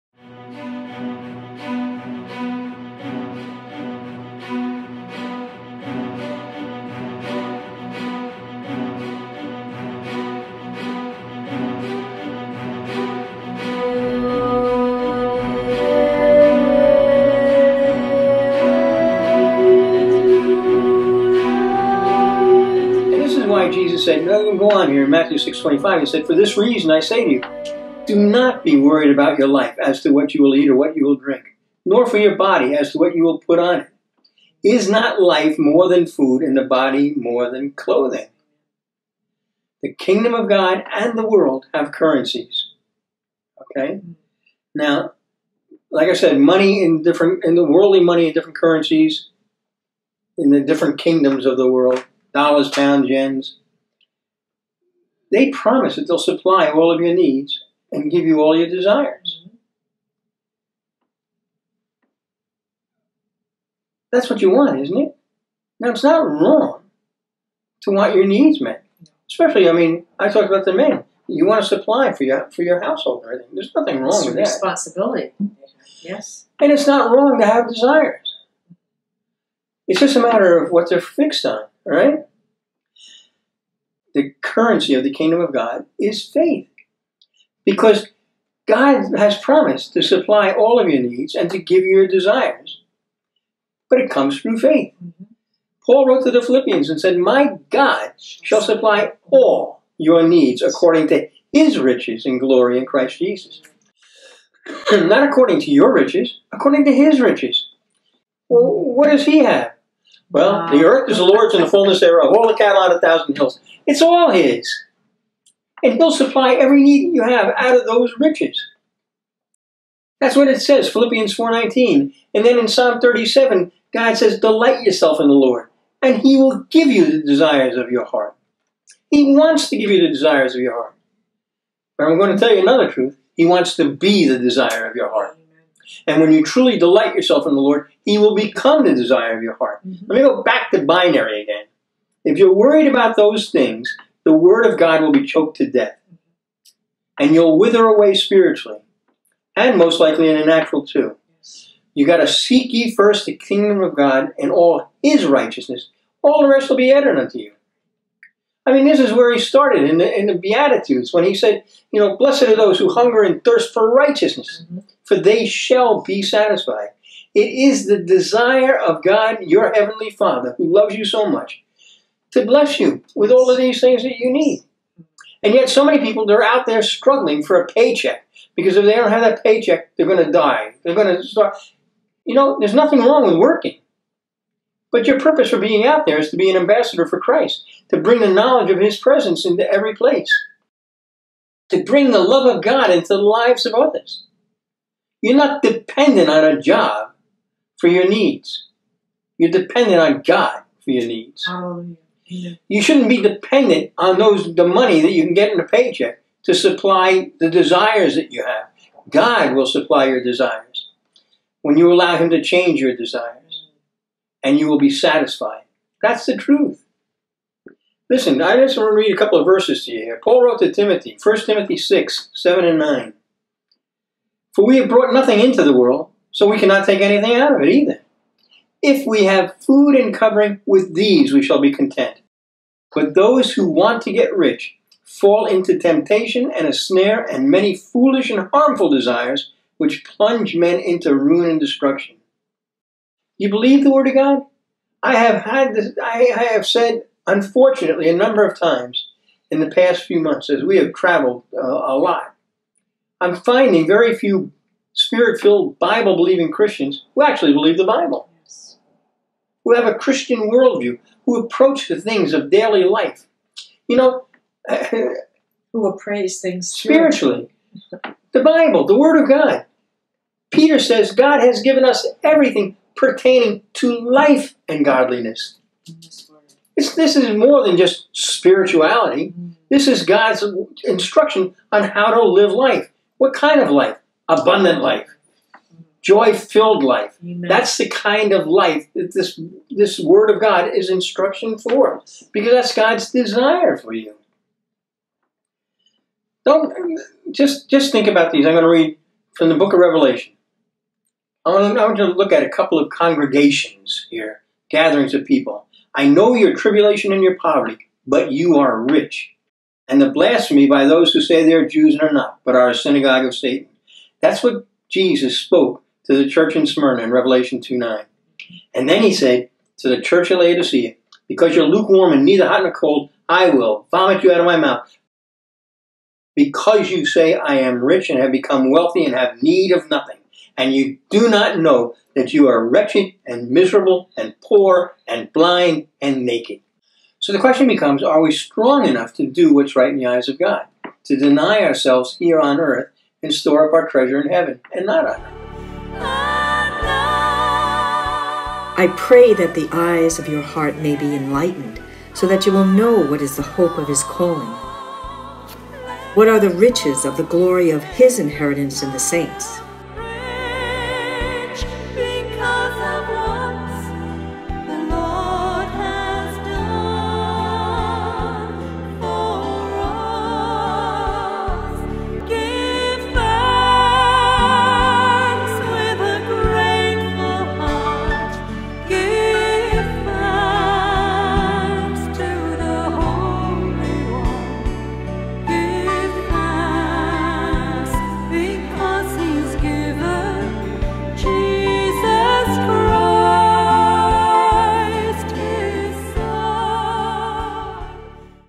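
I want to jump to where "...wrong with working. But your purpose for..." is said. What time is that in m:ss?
3:02.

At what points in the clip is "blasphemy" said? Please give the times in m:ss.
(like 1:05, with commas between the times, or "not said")
5:10.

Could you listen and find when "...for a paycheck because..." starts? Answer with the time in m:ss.
2:57.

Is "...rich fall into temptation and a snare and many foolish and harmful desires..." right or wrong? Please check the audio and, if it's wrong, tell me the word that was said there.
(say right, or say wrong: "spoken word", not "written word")
right.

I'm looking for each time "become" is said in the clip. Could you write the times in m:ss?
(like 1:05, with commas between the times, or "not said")
2:18, 5:28, 5:37.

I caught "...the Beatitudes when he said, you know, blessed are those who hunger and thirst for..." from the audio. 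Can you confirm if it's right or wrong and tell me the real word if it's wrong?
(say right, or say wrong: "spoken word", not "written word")
right.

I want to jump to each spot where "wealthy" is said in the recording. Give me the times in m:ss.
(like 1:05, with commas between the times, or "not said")
5:28.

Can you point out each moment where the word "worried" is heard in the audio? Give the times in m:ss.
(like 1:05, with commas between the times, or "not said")
0:28, 2:22.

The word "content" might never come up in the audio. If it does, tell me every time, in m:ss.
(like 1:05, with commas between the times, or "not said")
3:51.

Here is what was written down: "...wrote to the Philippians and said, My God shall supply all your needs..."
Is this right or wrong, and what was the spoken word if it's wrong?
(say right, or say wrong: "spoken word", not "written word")
right.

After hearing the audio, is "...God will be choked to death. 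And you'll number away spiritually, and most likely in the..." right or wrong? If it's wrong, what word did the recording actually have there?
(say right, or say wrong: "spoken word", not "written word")
wrong: "wither", not "number".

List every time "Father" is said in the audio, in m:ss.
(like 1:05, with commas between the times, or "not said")
2:50.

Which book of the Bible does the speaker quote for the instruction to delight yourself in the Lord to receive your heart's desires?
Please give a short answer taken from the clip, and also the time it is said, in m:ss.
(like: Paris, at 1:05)
Psalm 37, at 2:02.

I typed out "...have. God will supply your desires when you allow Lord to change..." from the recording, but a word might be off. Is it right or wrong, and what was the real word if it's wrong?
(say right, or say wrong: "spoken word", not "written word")
wrong: "Him", not "Lord".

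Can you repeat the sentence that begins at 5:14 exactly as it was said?
That's what Jesus spoke to the church in Smyrna in Revelation 2 9.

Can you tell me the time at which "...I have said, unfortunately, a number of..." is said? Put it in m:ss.
4:06.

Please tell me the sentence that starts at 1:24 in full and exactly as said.
the currency of the kingdom of God is faith.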